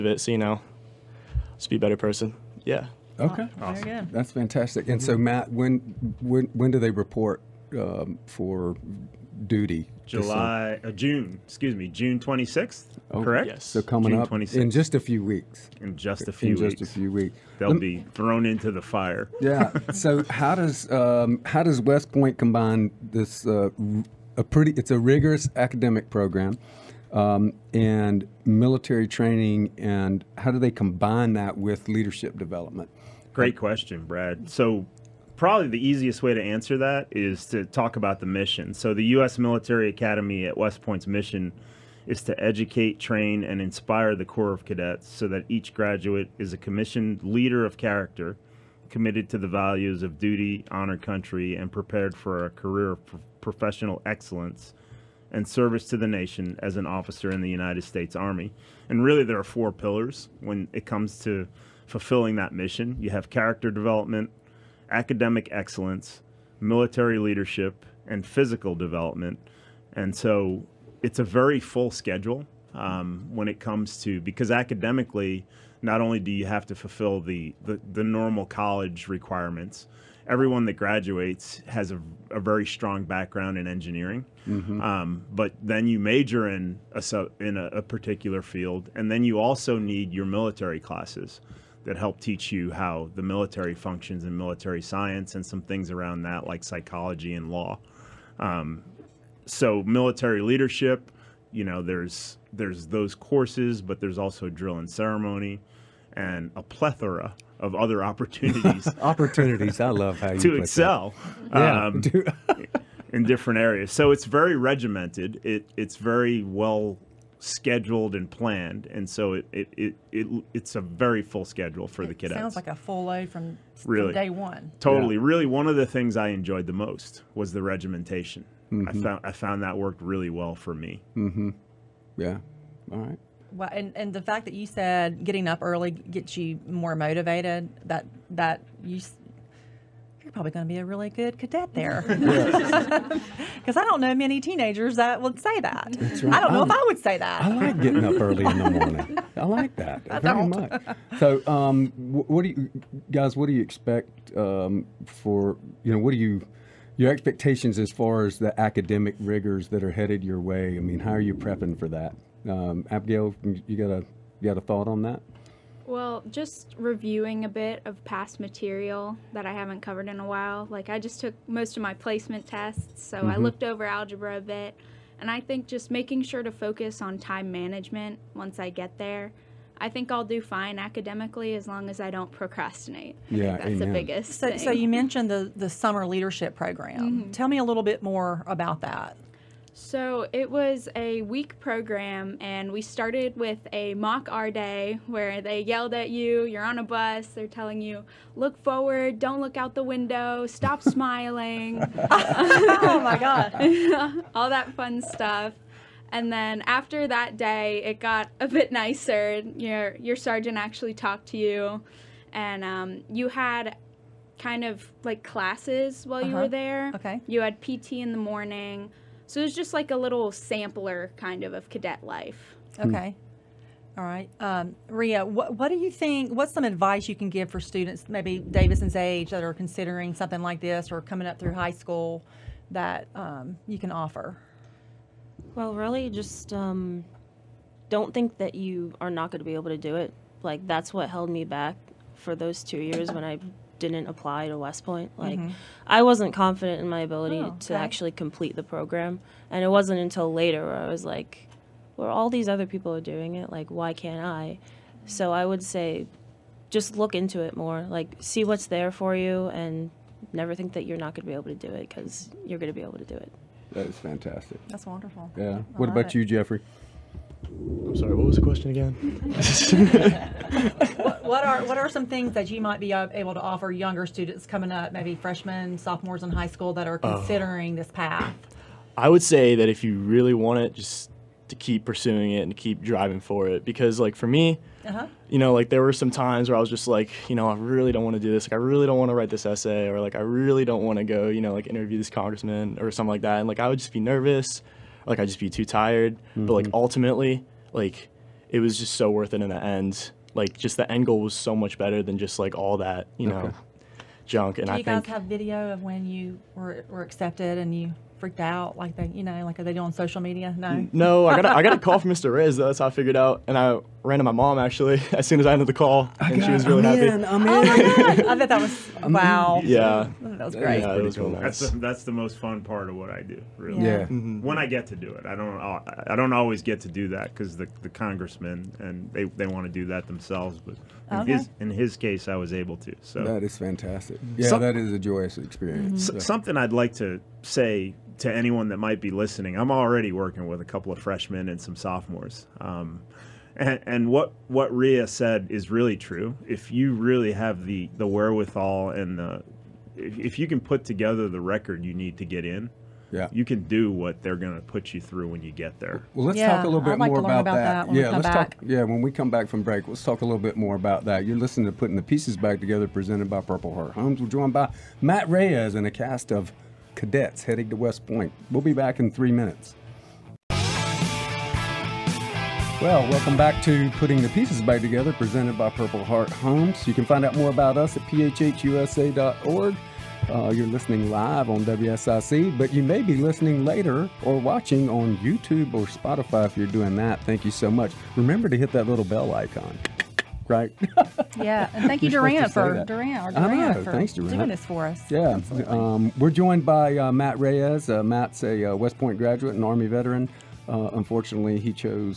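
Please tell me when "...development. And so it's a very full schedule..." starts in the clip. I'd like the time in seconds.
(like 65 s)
68 s.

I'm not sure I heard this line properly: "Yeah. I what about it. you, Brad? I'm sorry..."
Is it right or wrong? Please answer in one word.
wrong.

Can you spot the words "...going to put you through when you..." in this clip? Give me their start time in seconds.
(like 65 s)
354 s.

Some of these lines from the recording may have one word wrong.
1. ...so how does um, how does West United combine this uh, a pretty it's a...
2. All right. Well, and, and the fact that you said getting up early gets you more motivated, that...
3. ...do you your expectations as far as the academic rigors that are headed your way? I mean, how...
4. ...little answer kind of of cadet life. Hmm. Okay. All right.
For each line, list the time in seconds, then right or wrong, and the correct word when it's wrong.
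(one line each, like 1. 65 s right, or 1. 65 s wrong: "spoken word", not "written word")
1. 19 s wrong: "Point", not "United"
2. 132 s right
3. 156 s right
4. 219 s wrong: "sampler", not "answer".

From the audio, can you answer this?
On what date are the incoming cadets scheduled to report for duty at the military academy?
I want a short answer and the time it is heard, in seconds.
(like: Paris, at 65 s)
June 26, at 11 s.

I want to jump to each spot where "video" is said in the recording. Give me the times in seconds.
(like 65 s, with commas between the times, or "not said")
305 s.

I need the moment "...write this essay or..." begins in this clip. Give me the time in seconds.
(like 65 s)
289 s.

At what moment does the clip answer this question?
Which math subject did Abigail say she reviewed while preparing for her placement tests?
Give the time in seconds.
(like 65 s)
173 s.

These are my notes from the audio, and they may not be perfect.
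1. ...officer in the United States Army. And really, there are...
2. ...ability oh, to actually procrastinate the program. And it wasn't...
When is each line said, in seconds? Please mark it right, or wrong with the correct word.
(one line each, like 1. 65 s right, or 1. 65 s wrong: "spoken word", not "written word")
1. 56 s right
2. 247 s wrong: "complete", not "procrastinate".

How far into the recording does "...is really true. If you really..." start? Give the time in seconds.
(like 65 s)
345 s.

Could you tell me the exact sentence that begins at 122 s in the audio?
Sounds like a full load from really day one.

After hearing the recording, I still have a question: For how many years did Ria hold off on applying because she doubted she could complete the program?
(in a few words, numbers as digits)
2.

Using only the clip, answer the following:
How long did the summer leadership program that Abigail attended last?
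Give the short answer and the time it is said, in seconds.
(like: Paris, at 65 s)
A week, at 190 s.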